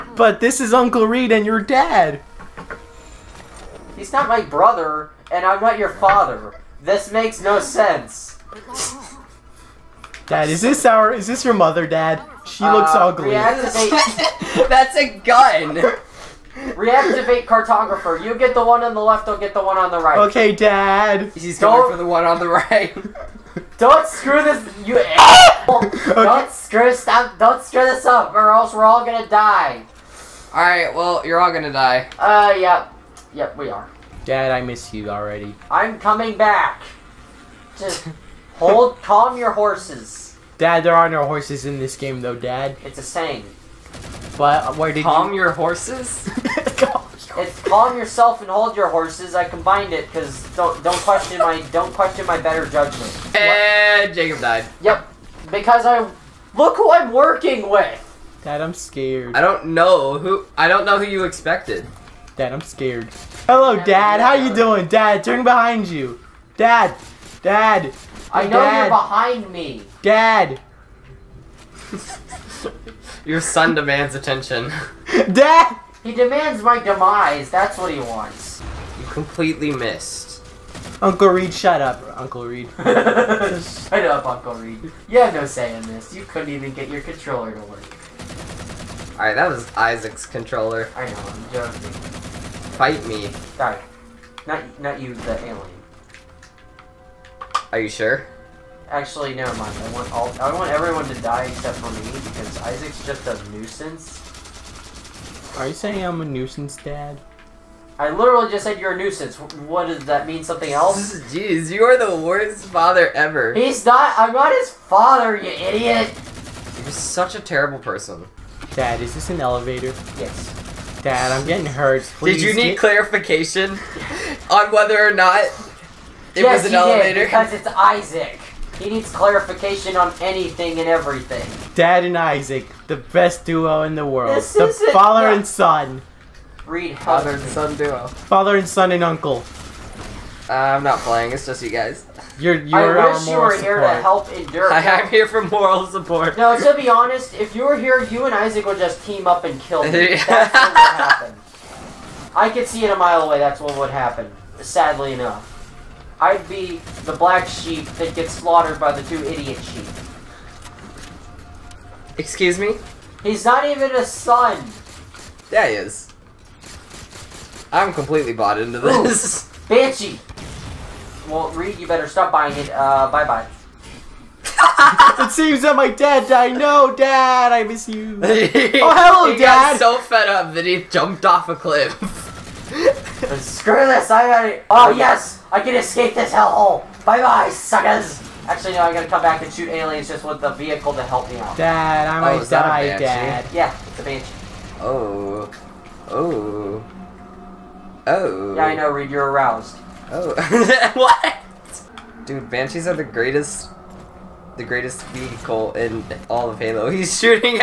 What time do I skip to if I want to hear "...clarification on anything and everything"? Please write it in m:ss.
2:09.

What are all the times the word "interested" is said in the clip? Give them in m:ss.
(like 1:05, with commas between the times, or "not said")
not said.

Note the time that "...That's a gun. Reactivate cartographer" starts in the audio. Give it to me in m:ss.
0:14.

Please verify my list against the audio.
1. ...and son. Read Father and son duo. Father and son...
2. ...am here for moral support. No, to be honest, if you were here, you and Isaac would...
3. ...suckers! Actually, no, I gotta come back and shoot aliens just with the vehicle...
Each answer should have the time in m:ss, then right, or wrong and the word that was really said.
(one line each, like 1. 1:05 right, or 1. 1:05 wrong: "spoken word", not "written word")
1. 2:15 right
2. 2:24 right
3. 3:07 right.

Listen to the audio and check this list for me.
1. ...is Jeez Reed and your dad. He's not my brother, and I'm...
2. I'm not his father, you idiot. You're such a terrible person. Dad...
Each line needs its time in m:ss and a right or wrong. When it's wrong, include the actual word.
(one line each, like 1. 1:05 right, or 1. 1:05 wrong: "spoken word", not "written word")
1. 0:00 wrong: "Uncle", not "Jeez"
2. 1:54 right.